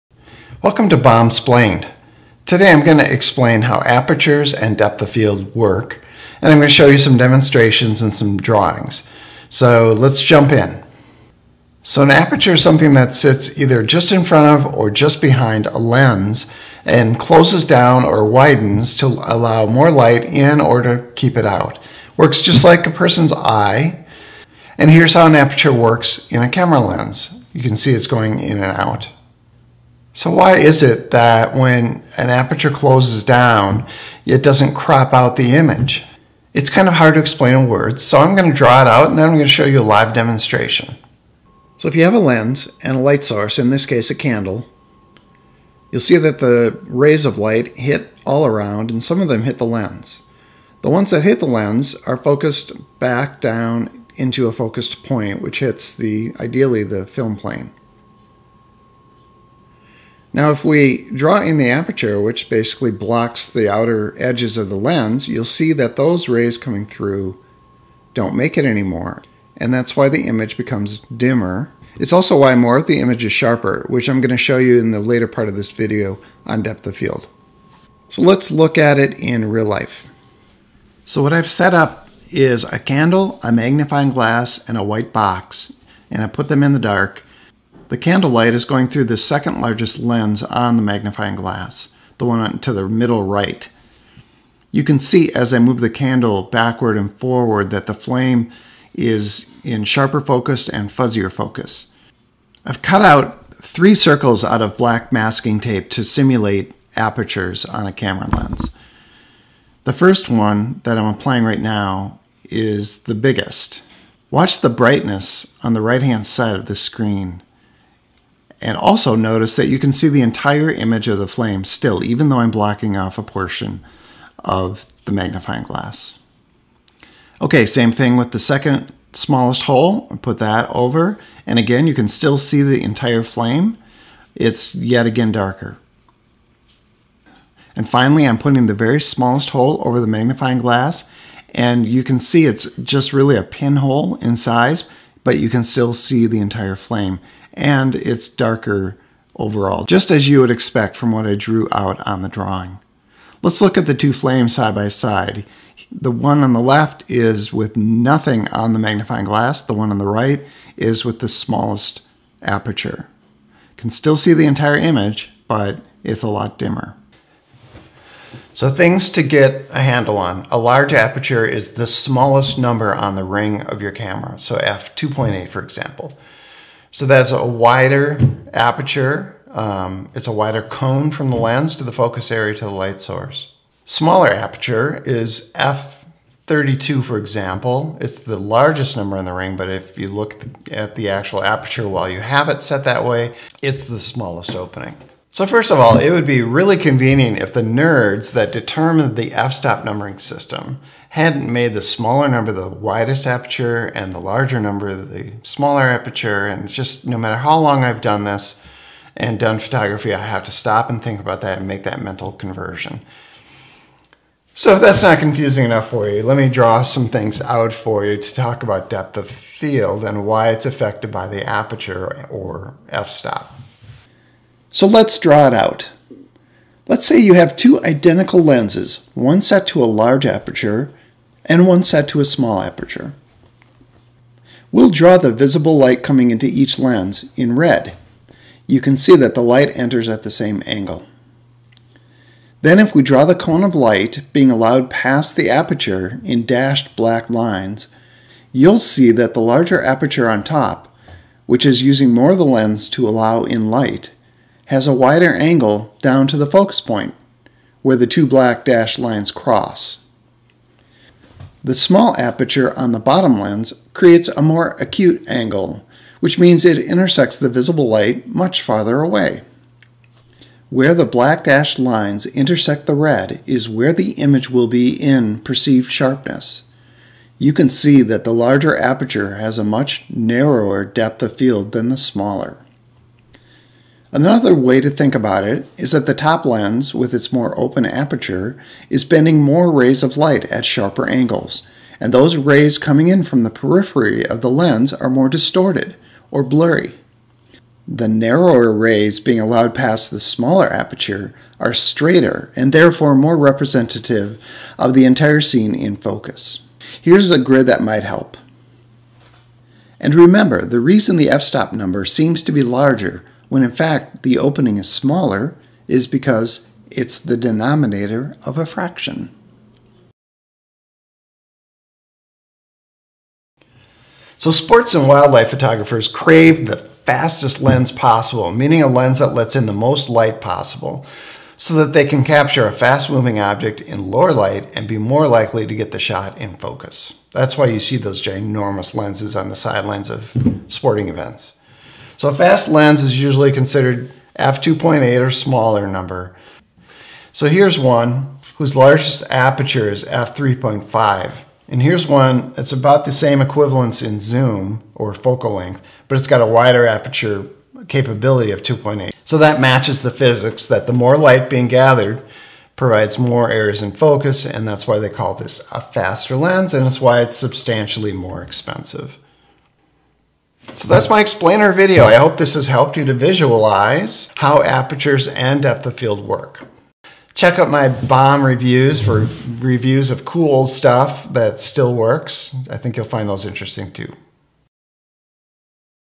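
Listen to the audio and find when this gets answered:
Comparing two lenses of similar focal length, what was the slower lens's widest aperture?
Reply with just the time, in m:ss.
5:50.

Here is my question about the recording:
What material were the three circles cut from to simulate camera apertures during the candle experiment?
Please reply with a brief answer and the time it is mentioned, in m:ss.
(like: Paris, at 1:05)
black masking tape, at 1:44.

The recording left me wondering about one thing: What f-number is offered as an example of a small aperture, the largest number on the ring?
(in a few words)
f32.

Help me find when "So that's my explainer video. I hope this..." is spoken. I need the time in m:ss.
6:10.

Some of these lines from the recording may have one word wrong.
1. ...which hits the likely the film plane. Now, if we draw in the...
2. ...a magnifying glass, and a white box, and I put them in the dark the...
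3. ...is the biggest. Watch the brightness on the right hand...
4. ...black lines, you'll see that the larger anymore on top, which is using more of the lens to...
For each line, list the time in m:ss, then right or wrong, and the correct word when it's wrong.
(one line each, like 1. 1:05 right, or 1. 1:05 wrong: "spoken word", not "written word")
1. 0:55 wrong: "ideally", not "likely"
2. 1:23 right
3. 1:52 right
4. 4:06 wrong: "aperture", not "anymore".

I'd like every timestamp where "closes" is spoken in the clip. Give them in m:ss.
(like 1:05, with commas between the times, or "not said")
0:17, 0:32.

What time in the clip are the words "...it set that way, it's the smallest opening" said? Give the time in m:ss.
3:12.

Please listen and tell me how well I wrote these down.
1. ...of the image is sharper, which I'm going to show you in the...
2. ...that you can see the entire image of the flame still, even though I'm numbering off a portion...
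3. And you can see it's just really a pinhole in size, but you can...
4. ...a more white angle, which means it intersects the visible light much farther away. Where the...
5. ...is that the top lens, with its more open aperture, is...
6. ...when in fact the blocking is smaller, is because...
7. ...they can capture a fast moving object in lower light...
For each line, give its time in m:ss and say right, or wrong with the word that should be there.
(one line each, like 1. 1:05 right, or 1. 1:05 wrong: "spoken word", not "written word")
1. 1:12 right
2. 1:59 wrong: "blocking", not "numbering"
3. 2:21 right
4. 4:24 wrong: "acute", not "white"
5. 4:45 right
6. 5:13 wrong: "opening", not "blocking"
7. 5:31 right.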